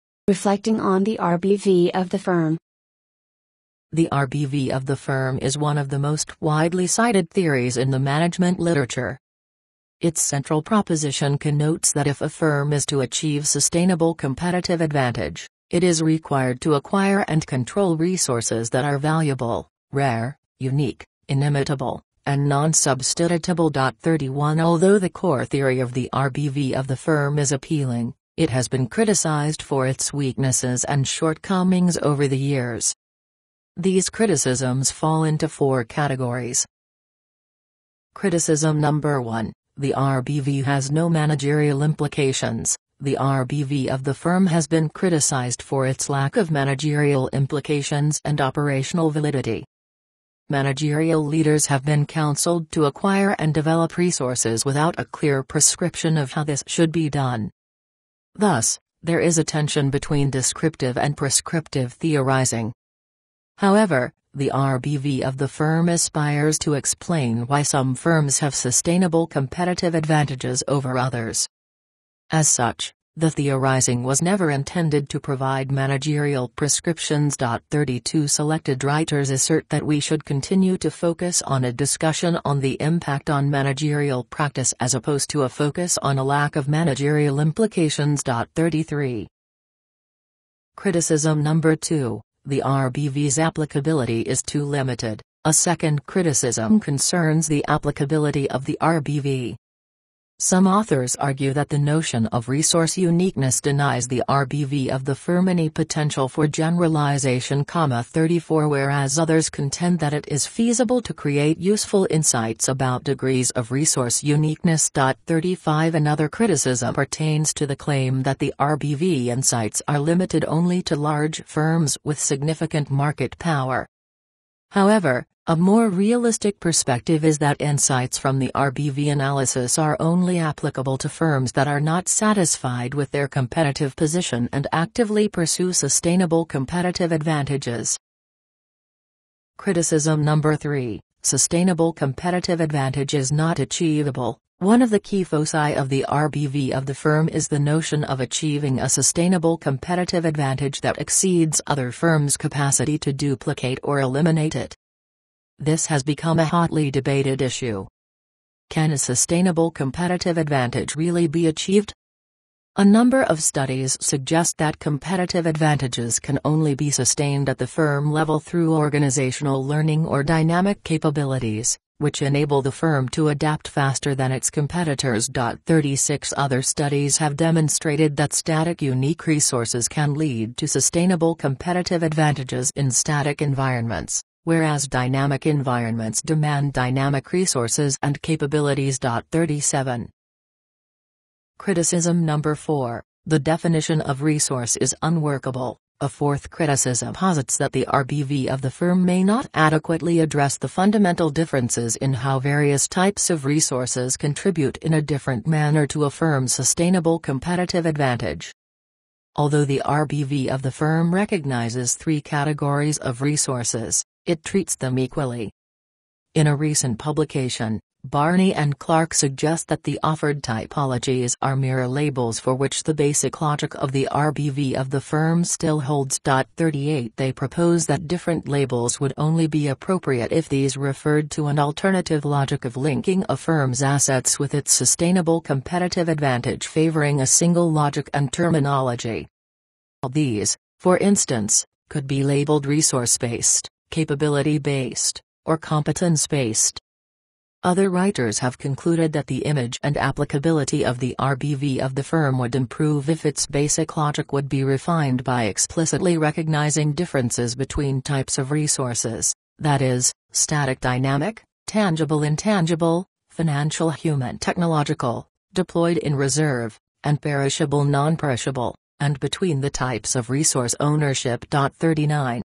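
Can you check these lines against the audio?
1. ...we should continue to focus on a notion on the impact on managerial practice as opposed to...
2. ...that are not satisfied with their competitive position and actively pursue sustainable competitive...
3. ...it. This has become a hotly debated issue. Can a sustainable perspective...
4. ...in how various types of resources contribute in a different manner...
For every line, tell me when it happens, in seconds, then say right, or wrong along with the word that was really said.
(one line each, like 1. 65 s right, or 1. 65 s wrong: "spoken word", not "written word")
1. 79 s wrong: "discussion", not "notion"
2. 131 s right
3. 154 s wrong: "competitive", not "perspective"
4. 201 s right.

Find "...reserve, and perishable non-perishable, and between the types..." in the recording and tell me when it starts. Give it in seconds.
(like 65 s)
266 s.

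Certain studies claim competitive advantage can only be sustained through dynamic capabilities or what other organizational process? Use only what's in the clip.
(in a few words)
Organizational learning.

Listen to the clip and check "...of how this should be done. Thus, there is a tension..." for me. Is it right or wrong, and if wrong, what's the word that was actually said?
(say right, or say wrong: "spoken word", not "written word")
right.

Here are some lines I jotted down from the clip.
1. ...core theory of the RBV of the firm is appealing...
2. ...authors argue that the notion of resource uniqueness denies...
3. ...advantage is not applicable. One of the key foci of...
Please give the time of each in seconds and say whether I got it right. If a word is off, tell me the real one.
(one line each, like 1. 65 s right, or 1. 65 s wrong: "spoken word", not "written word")
1. 25 s right
2. 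100 s right
3. 142 s wrong: "achievable", not "applicable".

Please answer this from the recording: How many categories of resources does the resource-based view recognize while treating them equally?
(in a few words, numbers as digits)
3.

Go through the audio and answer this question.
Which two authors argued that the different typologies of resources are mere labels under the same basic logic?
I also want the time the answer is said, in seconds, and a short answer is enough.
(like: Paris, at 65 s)
Barney and Clark, at 218 s.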